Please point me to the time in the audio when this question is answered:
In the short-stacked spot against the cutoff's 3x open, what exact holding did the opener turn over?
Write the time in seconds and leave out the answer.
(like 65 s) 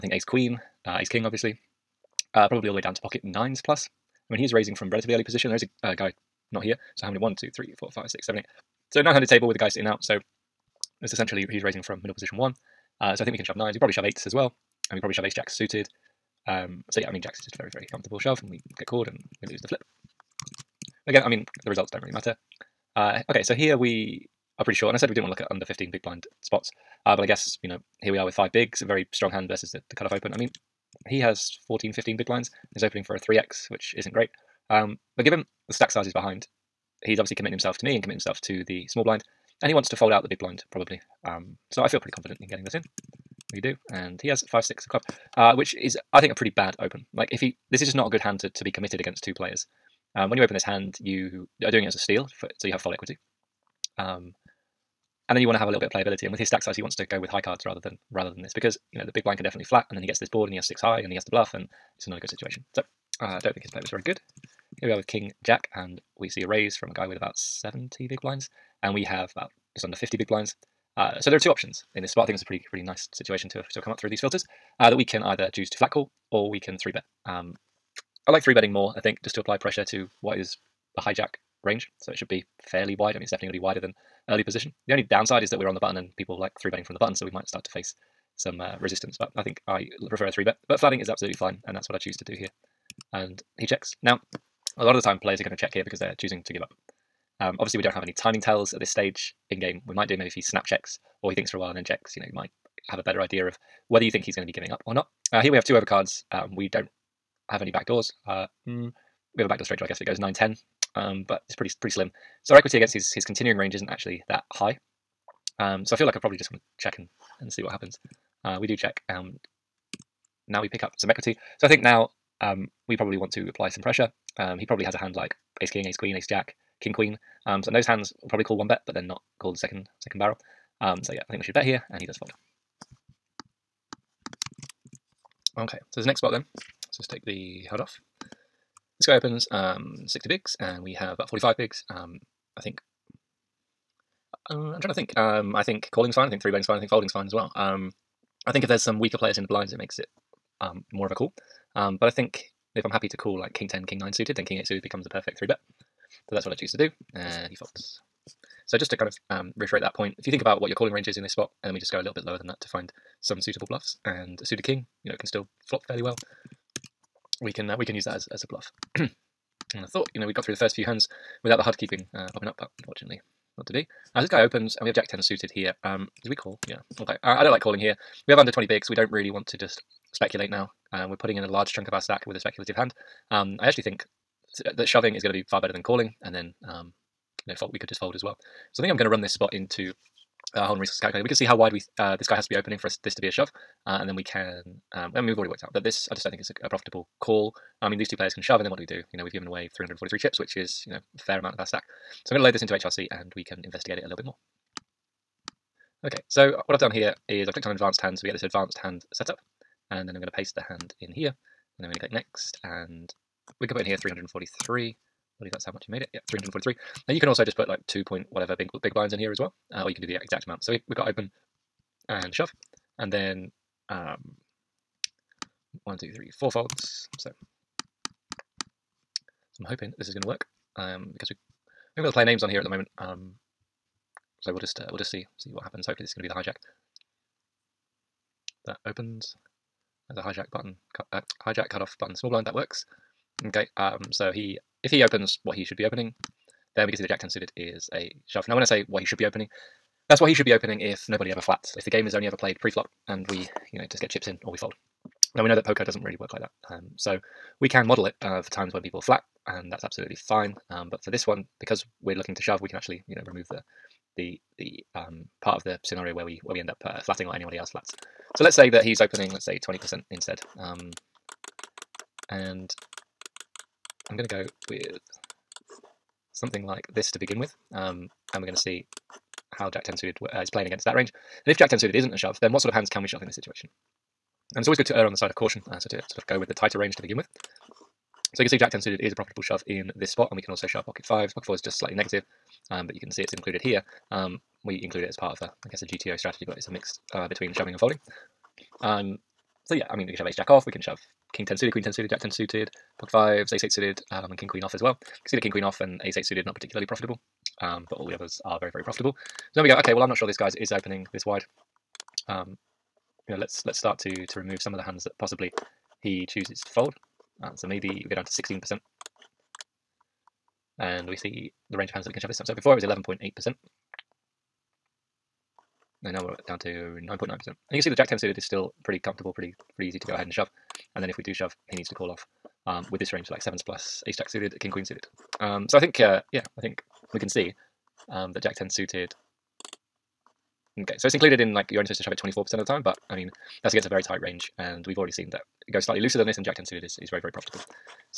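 44 s.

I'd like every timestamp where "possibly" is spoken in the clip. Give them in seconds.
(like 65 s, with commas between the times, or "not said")
315 s.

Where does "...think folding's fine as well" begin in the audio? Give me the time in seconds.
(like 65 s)
146 s.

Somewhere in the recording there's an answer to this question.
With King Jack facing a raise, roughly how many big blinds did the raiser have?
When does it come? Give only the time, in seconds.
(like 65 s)
67 s.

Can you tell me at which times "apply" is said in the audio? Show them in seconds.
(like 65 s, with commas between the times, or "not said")
79 s, 123 s.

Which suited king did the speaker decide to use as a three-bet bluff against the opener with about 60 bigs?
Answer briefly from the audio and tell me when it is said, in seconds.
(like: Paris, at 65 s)
King 8 suited, at 154 s.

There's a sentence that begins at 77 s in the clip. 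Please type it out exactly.
Um, I like three betting more.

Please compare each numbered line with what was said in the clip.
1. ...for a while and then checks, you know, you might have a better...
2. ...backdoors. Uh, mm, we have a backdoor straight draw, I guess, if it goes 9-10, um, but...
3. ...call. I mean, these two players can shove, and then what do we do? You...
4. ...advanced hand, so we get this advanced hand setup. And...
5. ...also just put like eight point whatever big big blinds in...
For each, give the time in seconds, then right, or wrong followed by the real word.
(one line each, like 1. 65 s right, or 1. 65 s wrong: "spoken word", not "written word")
1. 101 s right
2. 107 s right
3. 197 s right
4. 207 s right
5. 217 s wrong: "two", not "eight".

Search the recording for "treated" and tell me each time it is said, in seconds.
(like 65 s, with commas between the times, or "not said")
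not said.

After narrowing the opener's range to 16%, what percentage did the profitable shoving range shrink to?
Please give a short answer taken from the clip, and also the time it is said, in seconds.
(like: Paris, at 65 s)
9.9%, at 326 s.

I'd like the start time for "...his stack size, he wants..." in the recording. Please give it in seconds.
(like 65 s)
56 s.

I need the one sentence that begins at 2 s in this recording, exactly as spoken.
Uh, probably all the way down to pocket nines plus.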